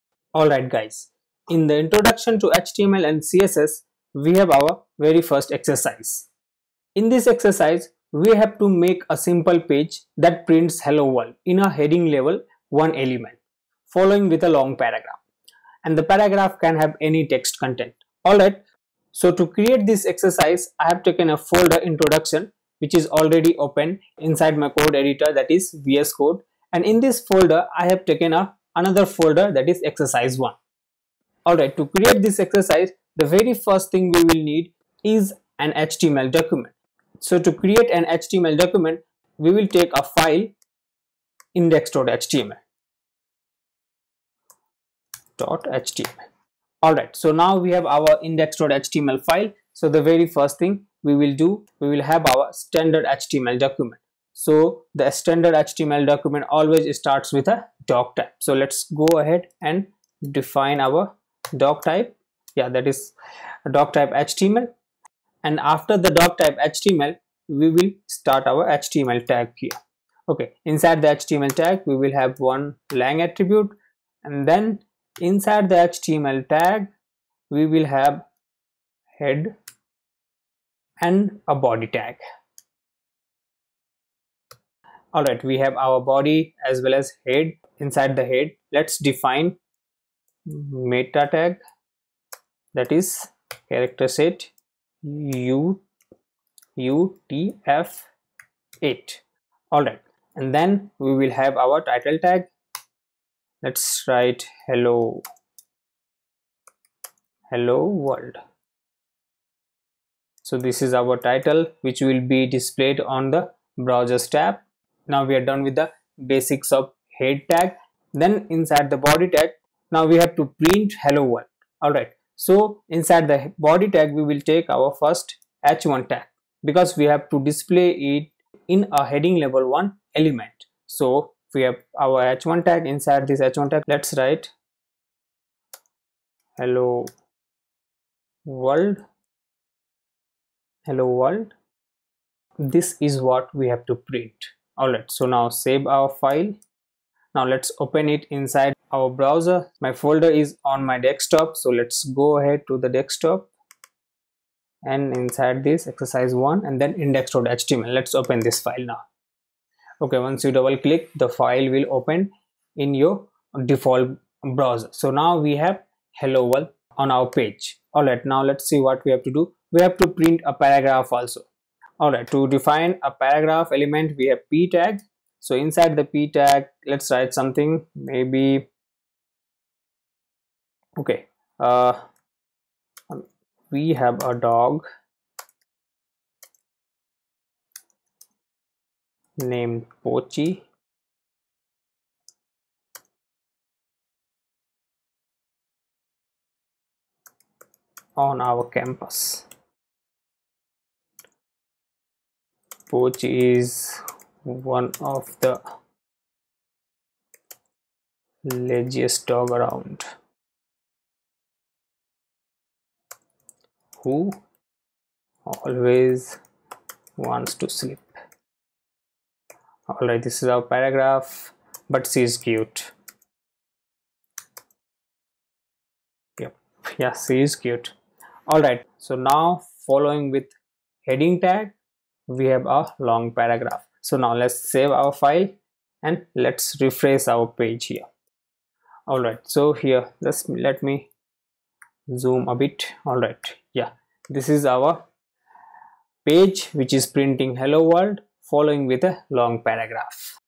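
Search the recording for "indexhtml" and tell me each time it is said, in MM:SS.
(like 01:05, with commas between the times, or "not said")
00:41, 00:48, 02:36.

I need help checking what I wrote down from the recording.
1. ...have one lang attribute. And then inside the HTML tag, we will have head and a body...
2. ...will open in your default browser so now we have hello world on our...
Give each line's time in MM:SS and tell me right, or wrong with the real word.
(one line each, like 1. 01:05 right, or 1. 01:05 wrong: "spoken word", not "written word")
1. 01:12 right
2. 02:41 right.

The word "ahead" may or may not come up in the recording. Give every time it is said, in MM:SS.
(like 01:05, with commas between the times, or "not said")
00:59, 02:32.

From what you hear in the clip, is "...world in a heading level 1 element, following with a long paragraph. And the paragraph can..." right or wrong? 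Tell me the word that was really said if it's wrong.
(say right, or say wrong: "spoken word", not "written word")
right.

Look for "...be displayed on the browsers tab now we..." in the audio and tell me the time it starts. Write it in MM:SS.
01:52.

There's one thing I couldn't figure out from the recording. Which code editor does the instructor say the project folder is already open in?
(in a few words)
VS Code.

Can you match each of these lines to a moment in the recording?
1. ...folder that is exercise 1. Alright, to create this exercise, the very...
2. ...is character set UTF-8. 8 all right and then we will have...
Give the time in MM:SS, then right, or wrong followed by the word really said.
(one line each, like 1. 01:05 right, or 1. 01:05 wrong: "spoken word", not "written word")
1. 00:29 right
2. 01:32 right.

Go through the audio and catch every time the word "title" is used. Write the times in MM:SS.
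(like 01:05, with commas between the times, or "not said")
01:41, 01:51.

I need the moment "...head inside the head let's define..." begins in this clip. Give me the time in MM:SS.
01:27.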